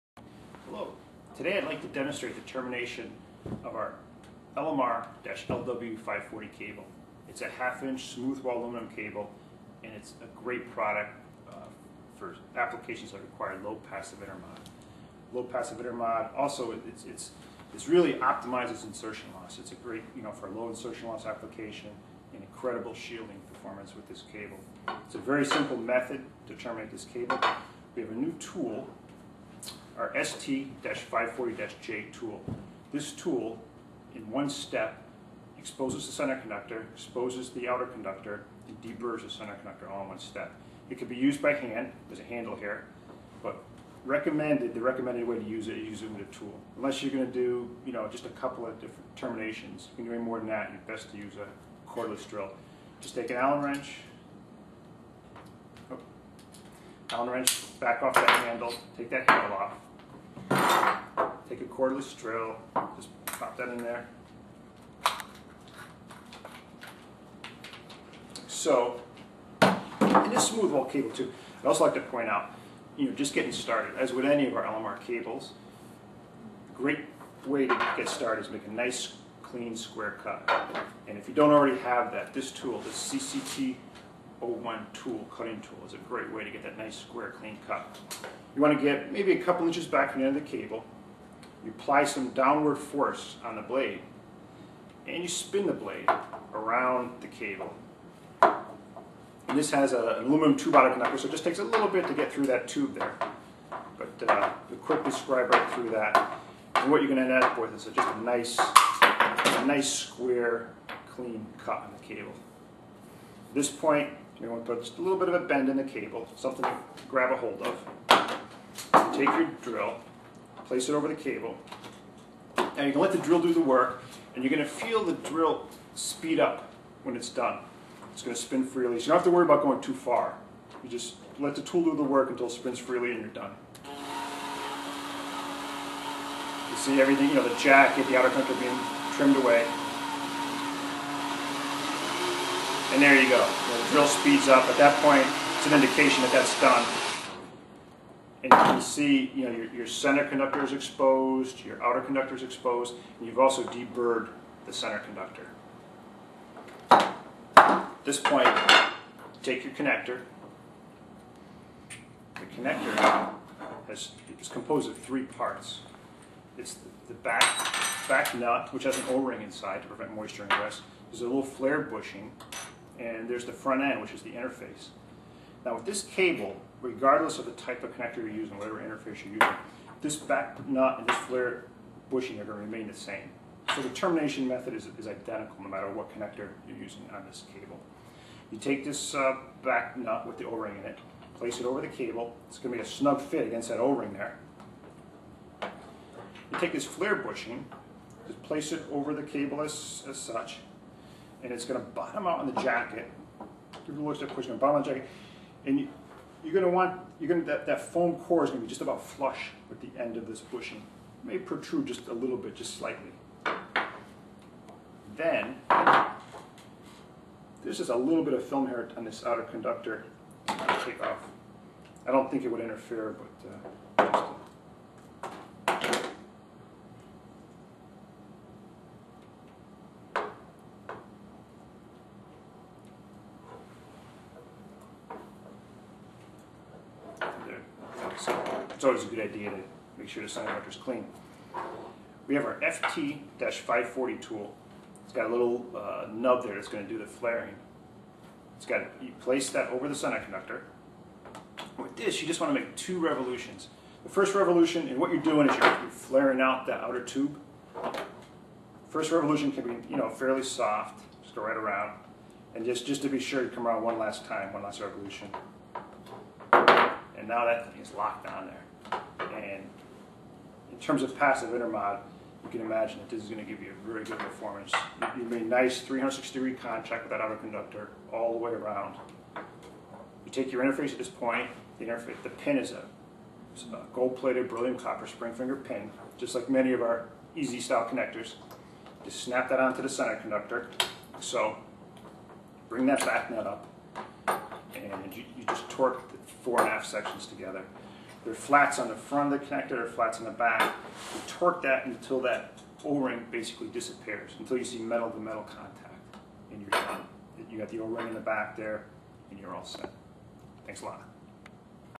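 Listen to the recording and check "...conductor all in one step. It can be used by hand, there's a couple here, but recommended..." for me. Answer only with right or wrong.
wrong.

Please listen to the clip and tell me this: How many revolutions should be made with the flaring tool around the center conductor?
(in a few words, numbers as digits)
2.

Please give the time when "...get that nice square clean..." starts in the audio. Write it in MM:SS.
01:26.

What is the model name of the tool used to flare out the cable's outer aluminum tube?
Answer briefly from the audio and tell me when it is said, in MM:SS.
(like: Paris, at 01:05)
FT-540, at 04:02.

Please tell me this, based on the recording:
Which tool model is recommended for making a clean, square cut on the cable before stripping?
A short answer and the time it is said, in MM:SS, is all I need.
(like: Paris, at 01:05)
CCT 01, at 01:22.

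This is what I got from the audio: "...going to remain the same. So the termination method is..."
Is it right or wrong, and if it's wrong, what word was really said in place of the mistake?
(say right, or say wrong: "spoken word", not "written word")
right.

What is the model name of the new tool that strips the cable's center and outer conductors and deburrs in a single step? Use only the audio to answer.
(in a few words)
ST-540-J.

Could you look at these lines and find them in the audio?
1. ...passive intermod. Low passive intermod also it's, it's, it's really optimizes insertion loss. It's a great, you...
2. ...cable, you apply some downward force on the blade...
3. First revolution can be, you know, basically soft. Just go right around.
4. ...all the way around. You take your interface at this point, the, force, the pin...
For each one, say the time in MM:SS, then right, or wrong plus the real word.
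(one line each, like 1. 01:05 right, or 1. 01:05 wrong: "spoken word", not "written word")
1. 00:13 right
2. 01:30 right
3. 04:18 wrong: "fairly", not "basically"
4. 04:38 wrong: "interface", not "force".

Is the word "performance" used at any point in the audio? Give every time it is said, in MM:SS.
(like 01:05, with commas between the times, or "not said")
00:23, 04:34.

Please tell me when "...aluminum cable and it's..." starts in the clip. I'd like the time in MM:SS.
00:08.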